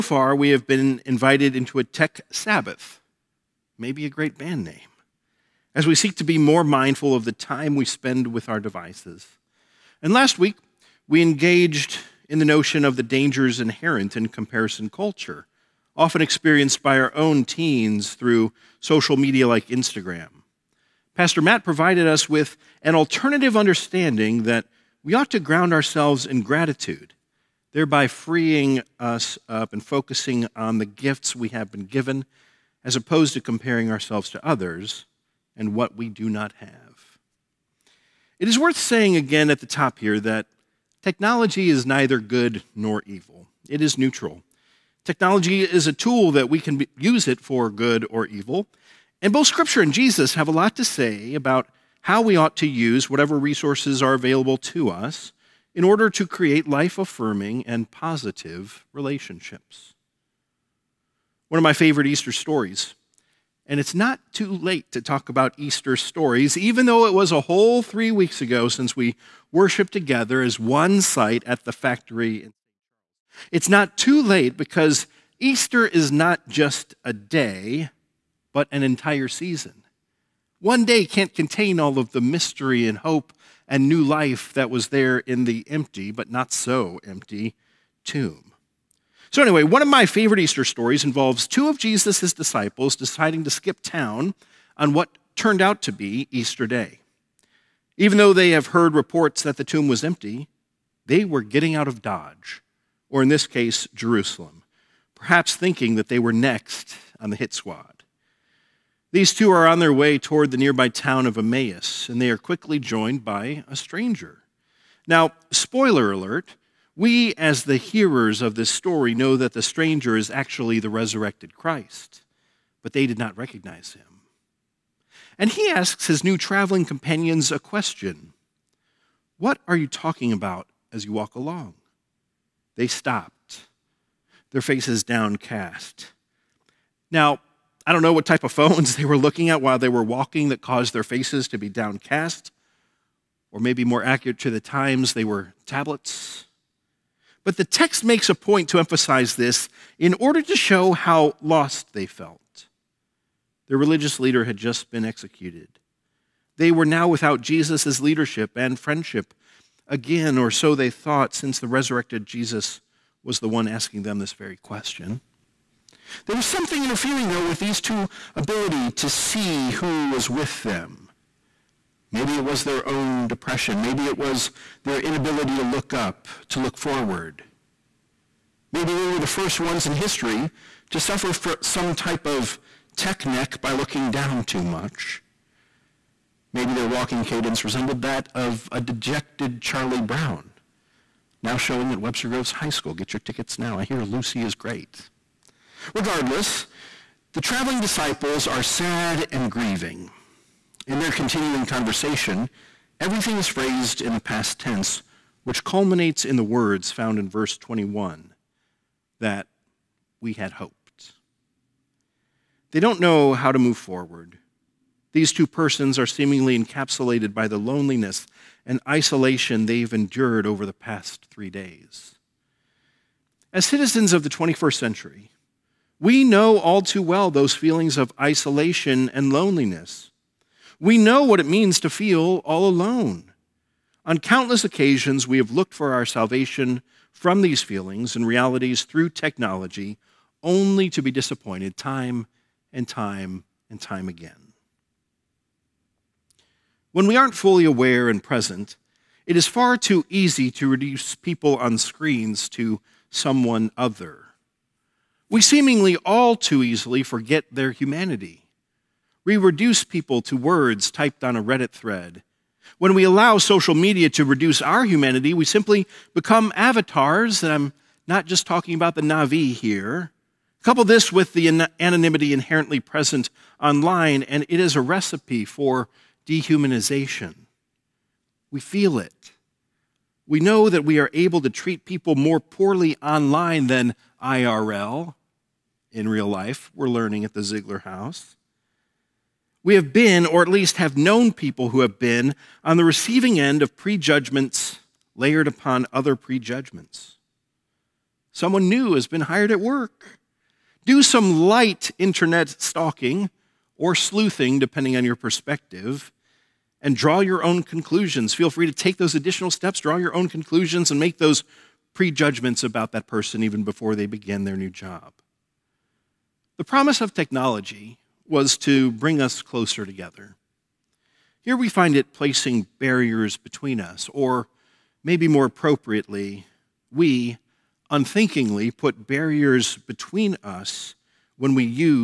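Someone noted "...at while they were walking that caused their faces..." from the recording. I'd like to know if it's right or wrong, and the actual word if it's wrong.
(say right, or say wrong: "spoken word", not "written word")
right.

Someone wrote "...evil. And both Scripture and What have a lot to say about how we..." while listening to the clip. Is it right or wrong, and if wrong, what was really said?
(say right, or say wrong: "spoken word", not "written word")
wrong: "Jesus", not "What".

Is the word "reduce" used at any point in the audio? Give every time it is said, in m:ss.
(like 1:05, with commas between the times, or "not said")
4:10, 4:19, 4:24.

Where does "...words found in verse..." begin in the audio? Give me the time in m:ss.
3:26.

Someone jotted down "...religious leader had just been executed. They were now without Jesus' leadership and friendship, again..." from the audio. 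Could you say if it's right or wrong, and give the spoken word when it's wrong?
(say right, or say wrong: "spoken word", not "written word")
right.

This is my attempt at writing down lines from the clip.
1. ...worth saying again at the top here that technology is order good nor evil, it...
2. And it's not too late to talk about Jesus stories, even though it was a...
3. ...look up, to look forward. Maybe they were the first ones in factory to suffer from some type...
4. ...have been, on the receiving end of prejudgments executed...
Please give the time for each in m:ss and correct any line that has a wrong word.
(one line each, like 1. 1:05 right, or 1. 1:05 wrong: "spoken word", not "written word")
1. 0:38 wrong: "neither", not "order"
2. 1:03 wrong: "Easter", not "Jesus"
3. 2:55 wrong: "history", not "factory"
4. 4:51 wrong: "layered", not "executed".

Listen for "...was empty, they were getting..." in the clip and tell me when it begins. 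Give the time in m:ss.
1:39.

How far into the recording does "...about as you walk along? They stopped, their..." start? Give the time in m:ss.
2:10.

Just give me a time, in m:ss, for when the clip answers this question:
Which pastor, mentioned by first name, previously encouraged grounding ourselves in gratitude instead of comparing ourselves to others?
0:21.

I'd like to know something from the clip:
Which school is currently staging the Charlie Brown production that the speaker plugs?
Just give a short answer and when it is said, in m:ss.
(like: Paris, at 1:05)
Webster Groves High School, at 3:12.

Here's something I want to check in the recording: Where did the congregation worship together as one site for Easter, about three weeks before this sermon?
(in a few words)
the factory.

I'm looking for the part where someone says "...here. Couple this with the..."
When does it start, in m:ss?
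4:29.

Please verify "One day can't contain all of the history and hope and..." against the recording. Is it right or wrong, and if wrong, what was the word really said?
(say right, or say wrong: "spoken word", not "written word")
wrong: "mystery", not "history".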